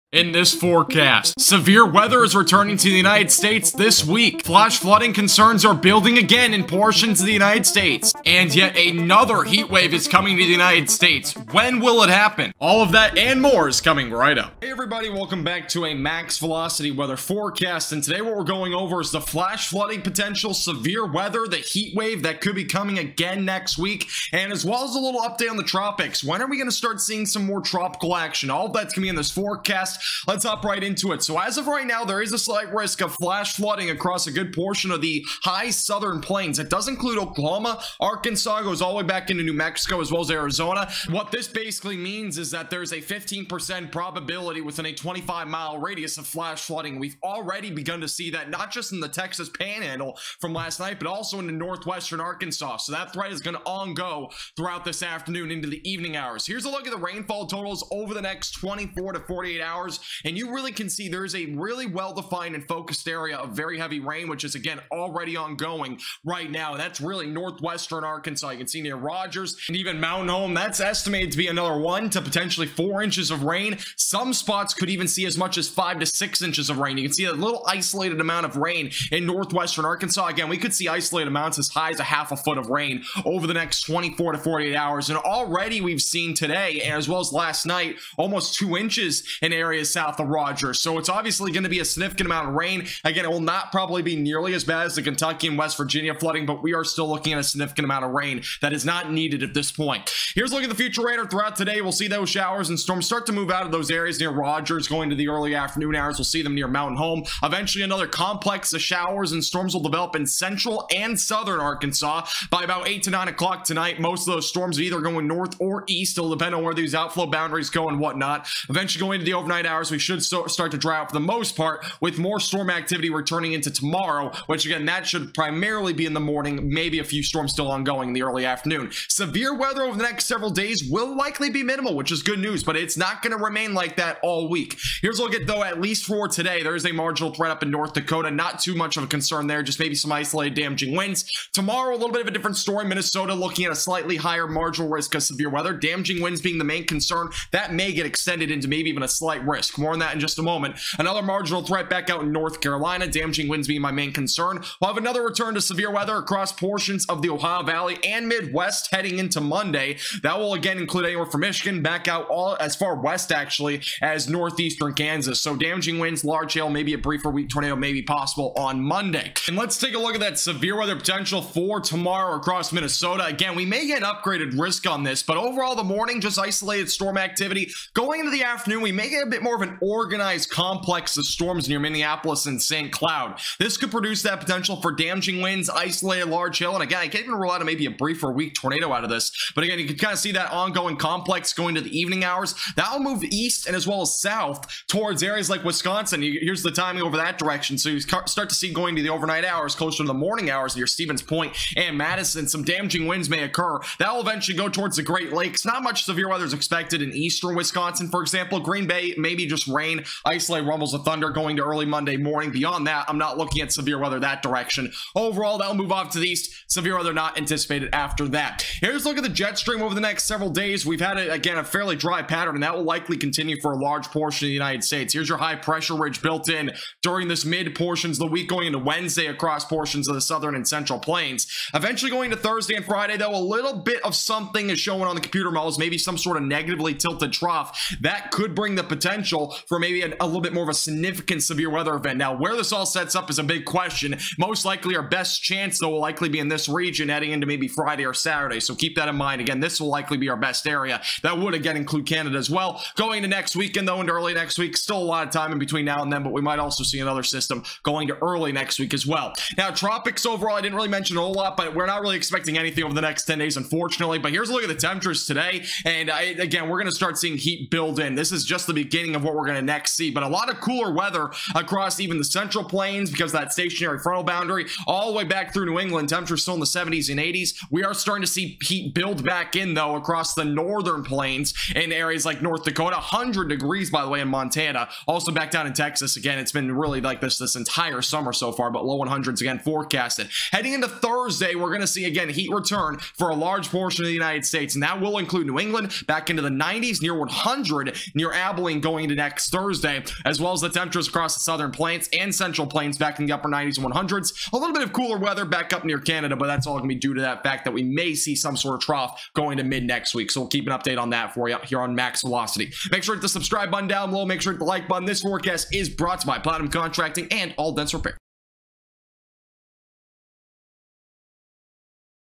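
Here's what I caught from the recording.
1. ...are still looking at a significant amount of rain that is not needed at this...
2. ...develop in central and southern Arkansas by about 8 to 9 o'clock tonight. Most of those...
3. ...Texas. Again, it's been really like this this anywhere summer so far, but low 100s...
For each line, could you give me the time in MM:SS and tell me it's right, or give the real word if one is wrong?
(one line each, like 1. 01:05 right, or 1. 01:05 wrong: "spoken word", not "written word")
1. 01:36 right
2. 01:49 right
3. 04:45 wrong: "entire", not "anywhere".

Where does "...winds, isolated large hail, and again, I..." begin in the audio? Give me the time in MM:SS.
03:05.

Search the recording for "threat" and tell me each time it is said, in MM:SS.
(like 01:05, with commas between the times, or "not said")
00:53, 02:17, 02:31.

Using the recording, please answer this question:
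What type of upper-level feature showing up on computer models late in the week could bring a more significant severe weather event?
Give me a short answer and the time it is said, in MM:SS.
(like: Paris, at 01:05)
negatively tilted trough, at 03:56.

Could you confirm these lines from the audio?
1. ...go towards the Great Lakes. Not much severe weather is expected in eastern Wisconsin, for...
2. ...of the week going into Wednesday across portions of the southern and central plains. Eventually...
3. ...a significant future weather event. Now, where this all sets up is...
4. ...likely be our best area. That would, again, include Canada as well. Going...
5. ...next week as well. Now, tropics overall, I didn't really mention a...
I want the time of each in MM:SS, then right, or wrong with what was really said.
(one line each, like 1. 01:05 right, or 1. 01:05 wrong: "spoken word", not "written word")
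1. 03:24 right
2. 03:48 right
3. 04:00 wrong: "severe", not "future"
4. 04:09 right
5. 04:18 right.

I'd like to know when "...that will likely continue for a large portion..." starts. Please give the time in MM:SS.
03:42.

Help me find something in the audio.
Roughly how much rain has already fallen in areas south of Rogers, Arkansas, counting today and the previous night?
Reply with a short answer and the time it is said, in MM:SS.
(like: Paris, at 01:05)
almost 2 inches, at 01:28.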